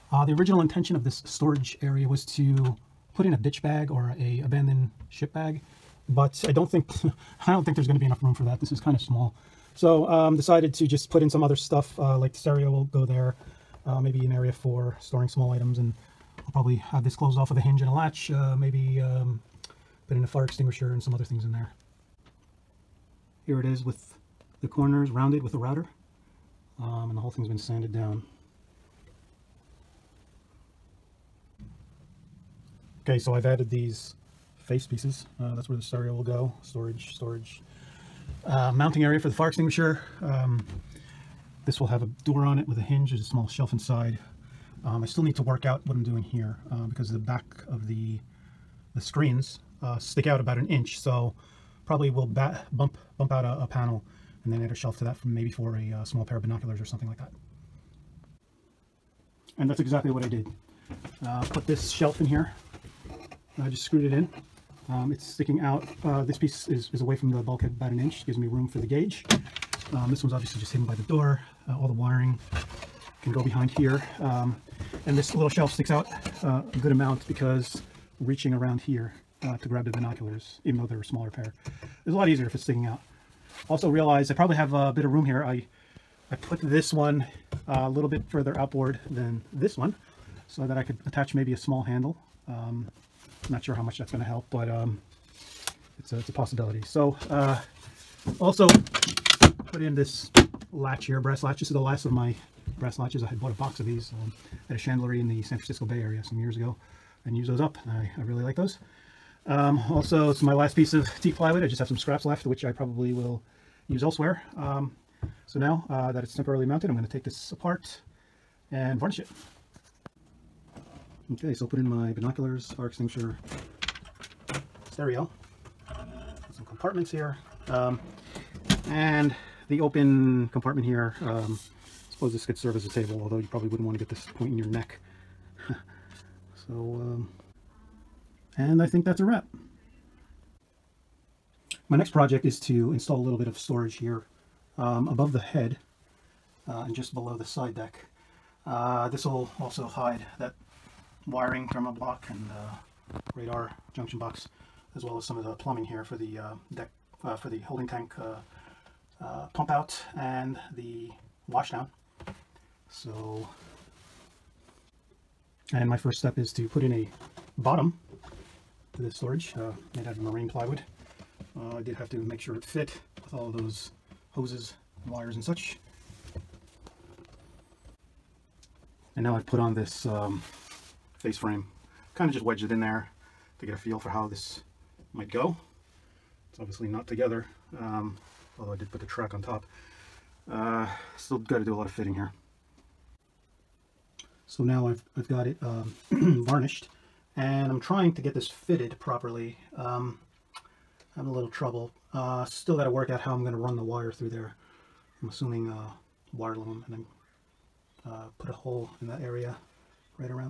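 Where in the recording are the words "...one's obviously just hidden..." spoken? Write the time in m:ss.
1:10.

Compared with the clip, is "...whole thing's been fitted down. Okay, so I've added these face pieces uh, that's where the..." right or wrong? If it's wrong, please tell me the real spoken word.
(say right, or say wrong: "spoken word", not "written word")
wrong: "sanded", not "fitted".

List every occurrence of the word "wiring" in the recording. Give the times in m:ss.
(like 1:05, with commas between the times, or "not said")
1:11, 2:31.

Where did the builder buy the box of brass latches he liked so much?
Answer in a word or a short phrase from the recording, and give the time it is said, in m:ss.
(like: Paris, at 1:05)
San Francisco Bay Area, at 1:45.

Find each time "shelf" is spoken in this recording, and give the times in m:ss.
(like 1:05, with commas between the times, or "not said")
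0:43, 0:54, 1:01, 1:15.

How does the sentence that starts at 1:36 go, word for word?
So uh, also put in this latch here, brass latch.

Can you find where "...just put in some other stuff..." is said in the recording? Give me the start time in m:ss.
0:10.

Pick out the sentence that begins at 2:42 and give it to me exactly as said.
So, and my first step is to put in a bottom to this storage uh, made out of marine plywood.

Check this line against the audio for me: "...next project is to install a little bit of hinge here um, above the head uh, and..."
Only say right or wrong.
wrong.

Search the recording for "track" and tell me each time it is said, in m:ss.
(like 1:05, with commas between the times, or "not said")
3:09.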